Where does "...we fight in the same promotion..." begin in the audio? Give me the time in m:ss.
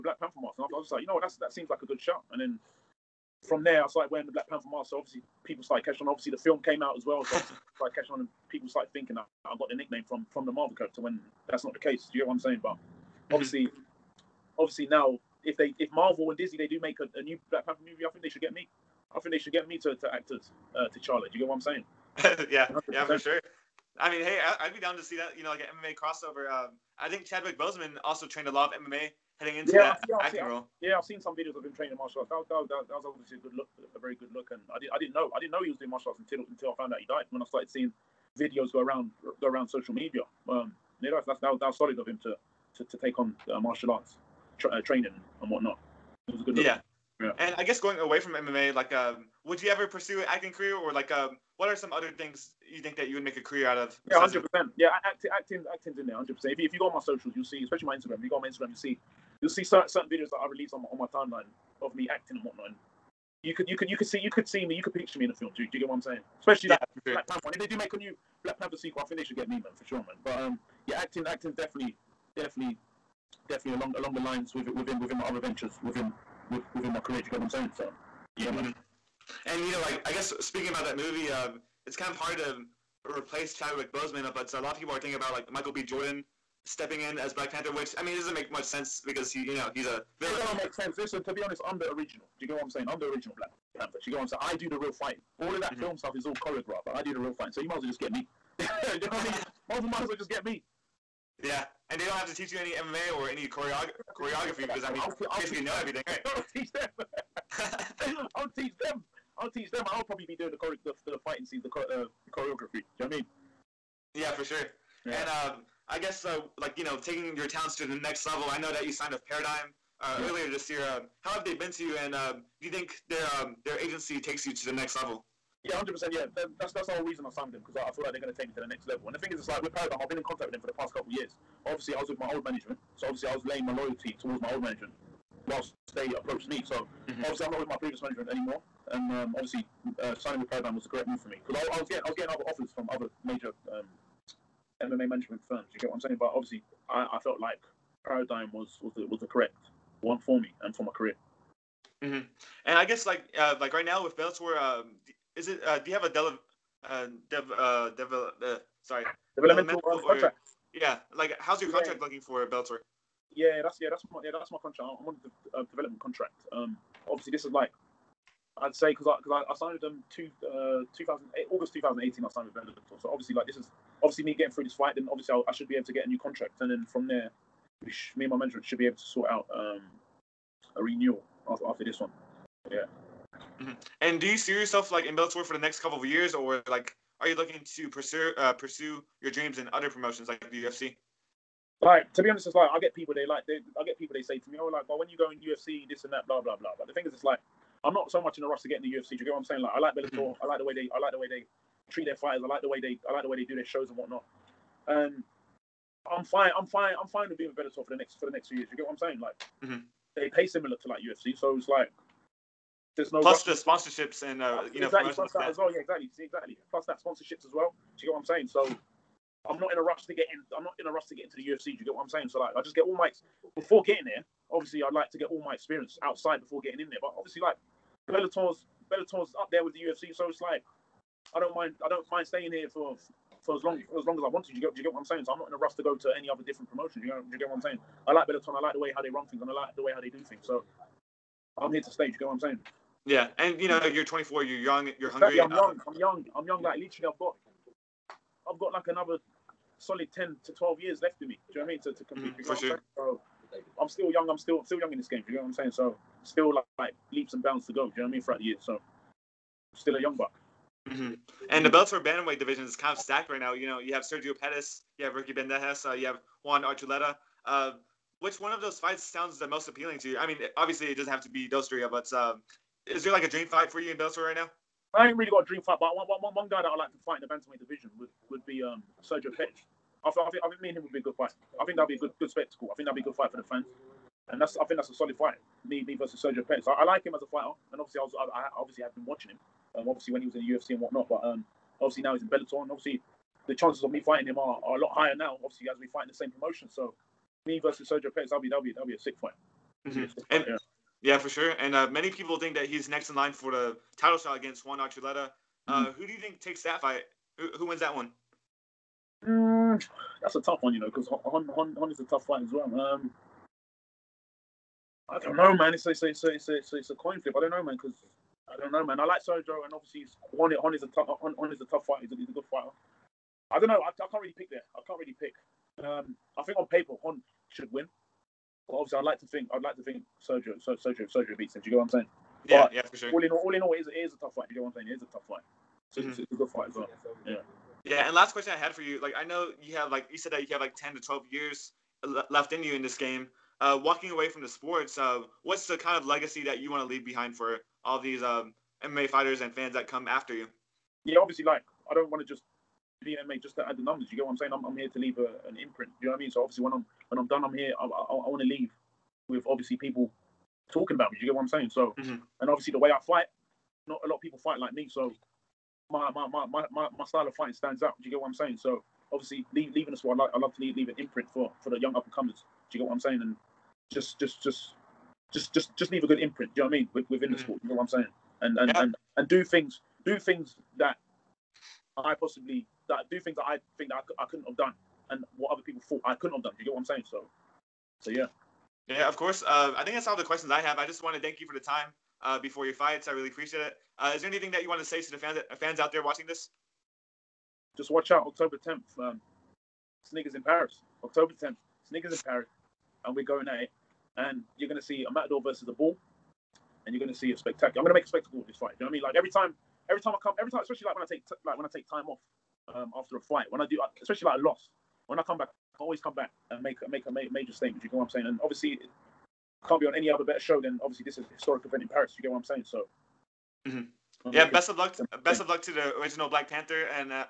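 4:55.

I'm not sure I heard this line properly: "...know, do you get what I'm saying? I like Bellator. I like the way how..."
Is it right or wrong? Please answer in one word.
right.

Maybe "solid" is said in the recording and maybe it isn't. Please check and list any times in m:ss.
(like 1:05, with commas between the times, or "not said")
0:41, 4:09, 4:44.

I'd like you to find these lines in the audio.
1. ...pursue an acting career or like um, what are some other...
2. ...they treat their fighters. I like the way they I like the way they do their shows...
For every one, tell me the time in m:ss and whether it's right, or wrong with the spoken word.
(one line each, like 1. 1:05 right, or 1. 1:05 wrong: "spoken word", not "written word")
1. 0:49 right
2. 3:21 right.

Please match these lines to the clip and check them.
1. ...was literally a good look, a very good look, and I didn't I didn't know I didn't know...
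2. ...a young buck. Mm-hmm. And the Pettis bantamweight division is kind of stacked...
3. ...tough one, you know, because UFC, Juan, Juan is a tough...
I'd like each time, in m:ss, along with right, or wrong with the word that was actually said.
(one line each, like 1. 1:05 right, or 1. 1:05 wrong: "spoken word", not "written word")
1. 0:32 wrong: "obviously", not "literally"
2. 4:19 wrong: "Bellator", not "Pettis"
3. 5:10 wrong: "Juan", not "UFC".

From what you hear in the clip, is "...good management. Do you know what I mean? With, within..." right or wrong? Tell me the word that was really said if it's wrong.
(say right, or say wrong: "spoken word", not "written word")
wrong: "imprint", not "management".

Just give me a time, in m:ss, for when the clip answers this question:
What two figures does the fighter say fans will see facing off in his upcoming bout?
6:45.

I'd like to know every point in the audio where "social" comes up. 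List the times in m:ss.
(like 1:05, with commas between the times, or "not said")
0:39, 0:56.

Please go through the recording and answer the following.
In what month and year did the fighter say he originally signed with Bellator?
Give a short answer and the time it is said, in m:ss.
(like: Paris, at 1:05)
August 2018, at 2:51.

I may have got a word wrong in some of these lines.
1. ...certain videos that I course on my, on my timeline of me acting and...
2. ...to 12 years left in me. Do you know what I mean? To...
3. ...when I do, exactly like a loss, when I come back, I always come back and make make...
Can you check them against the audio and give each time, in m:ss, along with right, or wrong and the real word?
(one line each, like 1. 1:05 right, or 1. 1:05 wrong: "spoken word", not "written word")
1. 0:59 wrong: "release", not "course"
2. 4:10 right
3. 6:53 wrong: "especially", not "exactly".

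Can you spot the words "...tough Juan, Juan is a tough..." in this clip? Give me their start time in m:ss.
5:20.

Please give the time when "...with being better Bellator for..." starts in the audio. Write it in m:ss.
3:27.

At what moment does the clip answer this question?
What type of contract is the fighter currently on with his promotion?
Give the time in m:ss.
2:45.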